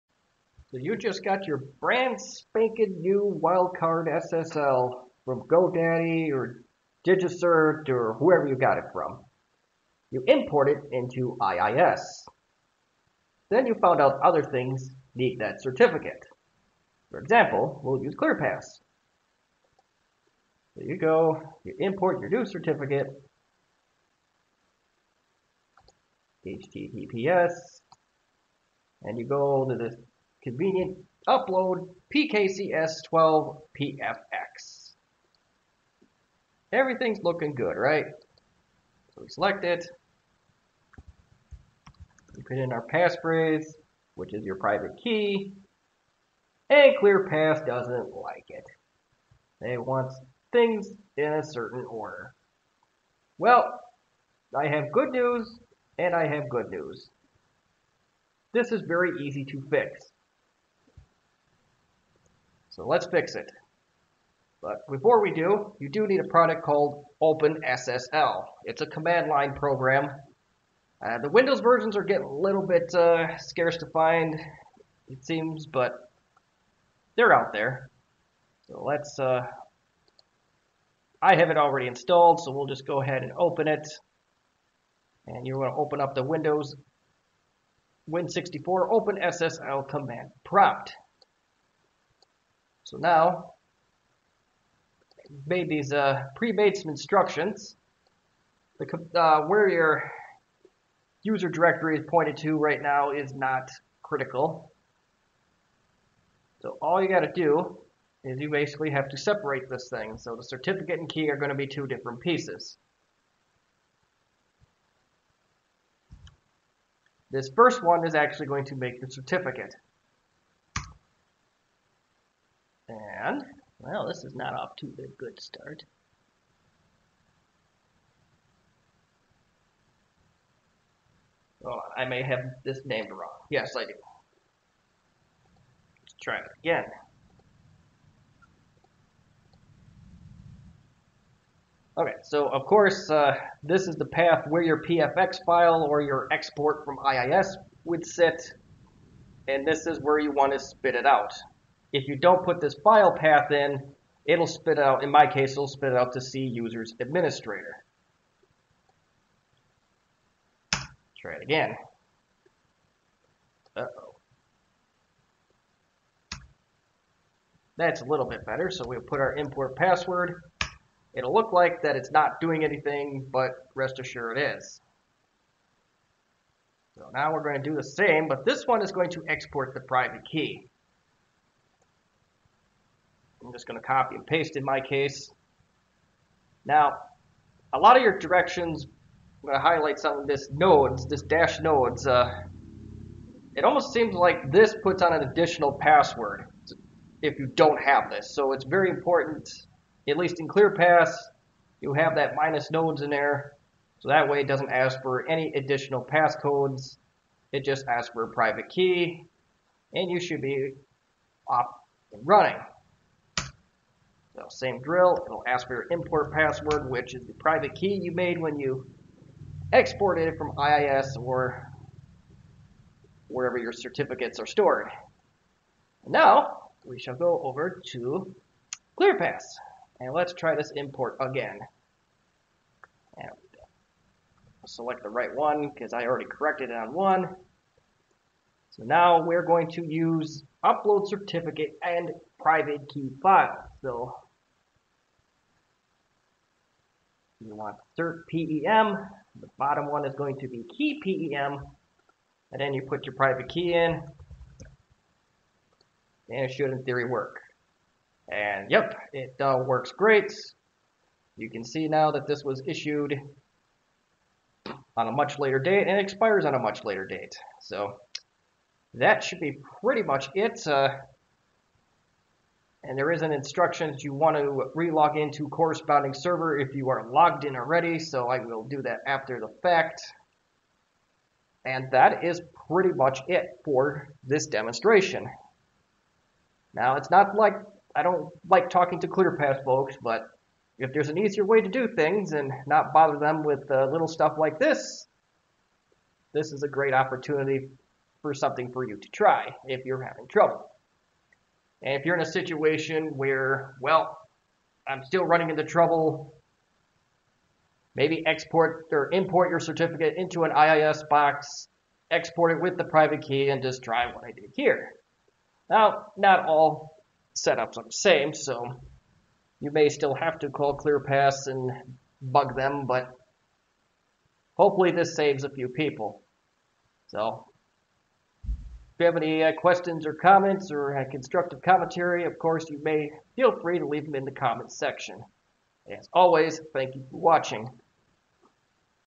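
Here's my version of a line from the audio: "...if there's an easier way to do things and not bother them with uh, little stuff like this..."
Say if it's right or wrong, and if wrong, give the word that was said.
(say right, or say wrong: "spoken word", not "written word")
right.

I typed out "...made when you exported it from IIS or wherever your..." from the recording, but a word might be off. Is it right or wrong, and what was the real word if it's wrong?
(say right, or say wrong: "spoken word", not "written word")
right.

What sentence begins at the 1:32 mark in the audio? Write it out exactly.
So now, made these uh, pre-made some instructions.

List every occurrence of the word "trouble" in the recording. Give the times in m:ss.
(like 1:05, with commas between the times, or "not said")
5:00, 5:05.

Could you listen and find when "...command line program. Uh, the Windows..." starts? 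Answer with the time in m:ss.
1:08.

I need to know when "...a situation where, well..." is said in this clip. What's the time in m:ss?
5:02.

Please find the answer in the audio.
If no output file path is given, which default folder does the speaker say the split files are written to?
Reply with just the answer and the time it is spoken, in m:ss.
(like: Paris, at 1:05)
C users administrator, at 2:36.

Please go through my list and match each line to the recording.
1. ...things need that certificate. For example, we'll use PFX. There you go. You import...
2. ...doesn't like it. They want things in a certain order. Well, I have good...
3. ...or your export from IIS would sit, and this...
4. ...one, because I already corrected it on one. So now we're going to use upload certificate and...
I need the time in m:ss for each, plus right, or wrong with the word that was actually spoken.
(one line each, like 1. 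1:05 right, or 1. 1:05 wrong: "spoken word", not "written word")
1. 0:14 wrong: "ClearPass", not "PFX"
2. 0:47 right
3. 2:25 right
4. 3:55 right.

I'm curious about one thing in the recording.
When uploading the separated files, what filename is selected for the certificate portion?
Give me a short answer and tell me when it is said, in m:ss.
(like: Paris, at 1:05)
cert PEM, at 4:07.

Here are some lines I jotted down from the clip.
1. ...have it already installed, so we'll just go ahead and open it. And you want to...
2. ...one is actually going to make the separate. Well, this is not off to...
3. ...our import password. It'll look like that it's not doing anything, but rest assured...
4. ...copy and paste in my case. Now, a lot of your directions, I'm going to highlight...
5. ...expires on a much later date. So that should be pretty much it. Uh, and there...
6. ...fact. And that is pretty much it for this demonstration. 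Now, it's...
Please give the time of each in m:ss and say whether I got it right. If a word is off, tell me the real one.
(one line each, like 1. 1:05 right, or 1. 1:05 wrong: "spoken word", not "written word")
1. 1:21 right
2. 1:57 wrong: "certificate", not "separate"
3. 2:49 right
4. 3:03 right
5. 4:25 right
6. 4:39 right.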